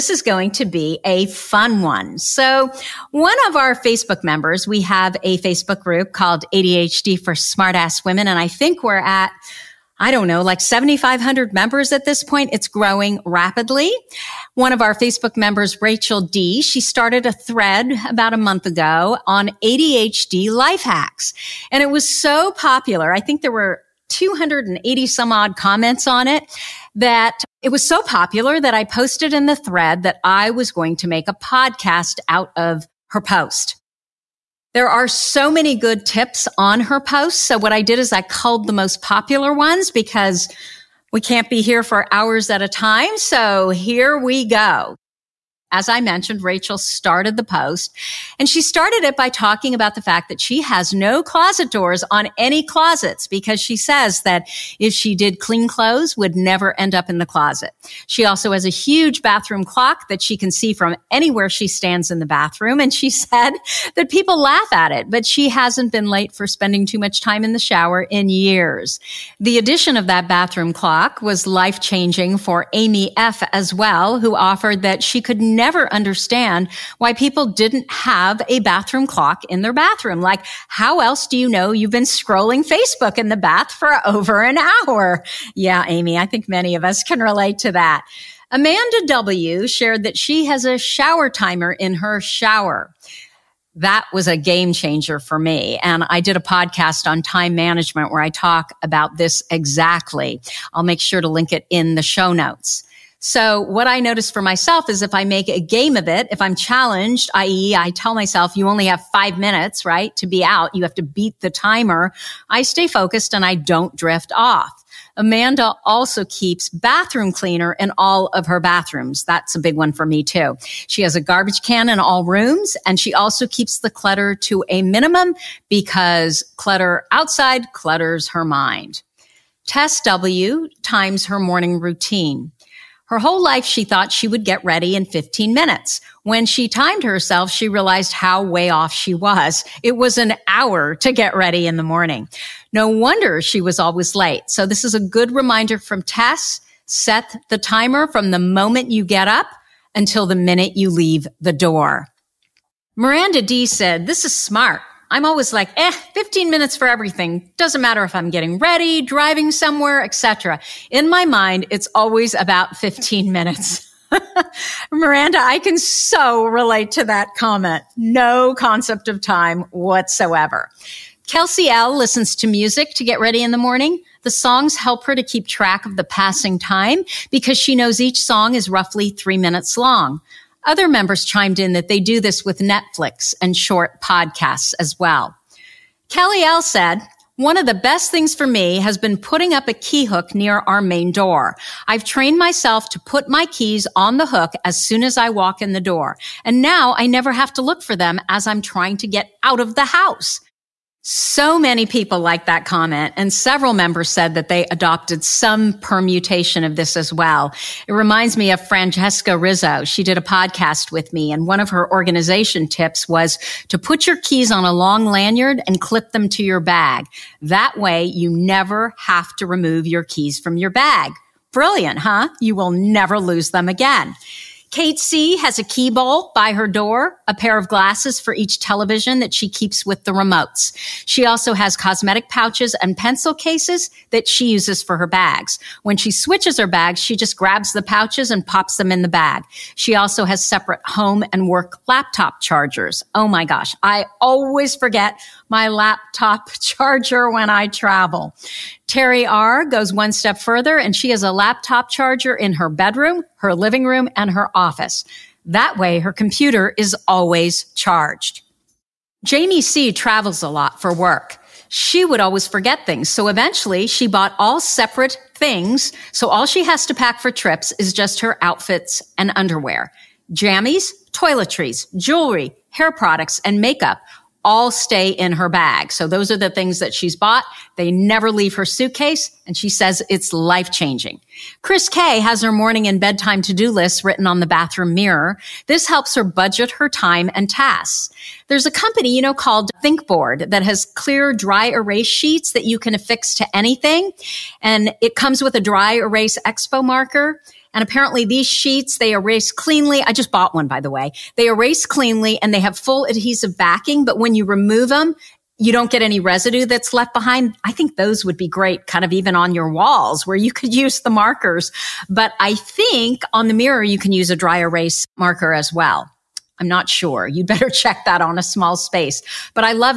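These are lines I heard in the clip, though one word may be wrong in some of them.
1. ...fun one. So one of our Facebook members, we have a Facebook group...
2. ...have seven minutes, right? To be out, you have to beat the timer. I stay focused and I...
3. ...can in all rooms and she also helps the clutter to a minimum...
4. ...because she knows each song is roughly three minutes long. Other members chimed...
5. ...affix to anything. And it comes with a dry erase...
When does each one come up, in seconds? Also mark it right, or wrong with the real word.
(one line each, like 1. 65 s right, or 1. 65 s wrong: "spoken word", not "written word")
1. 1 s right
2. 108 s wrong: "five", not "seven"
3. 121 s wrong: "keeps", not "helps"
4. 177 s right
5. 292 s right.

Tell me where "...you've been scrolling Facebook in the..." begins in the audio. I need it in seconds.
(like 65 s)
81 s.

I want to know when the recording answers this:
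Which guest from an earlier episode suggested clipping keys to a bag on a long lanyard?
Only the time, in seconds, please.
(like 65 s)
208 s.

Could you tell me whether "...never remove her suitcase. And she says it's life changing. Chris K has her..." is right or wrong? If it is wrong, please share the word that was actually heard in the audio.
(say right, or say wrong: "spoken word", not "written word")
wrong: "leave", not "remove".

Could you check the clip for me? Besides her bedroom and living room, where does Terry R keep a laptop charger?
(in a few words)
Her office.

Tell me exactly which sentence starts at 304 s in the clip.
But when you remove them, you don't get any residue that's left behind.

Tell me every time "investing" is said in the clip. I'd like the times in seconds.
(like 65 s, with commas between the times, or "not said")
not said.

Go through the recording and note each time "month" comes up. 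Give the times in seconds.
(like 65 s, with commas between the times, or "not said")
18 s.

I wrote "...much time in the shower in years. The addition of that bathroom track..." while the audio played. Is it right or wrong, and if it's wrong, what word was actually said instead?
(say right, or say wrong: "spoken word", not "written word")
wrong: "clock", not "track".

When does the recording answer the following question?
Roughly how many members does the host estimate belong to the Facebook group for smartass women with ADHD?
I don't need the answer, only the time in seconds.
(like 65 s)
10 s.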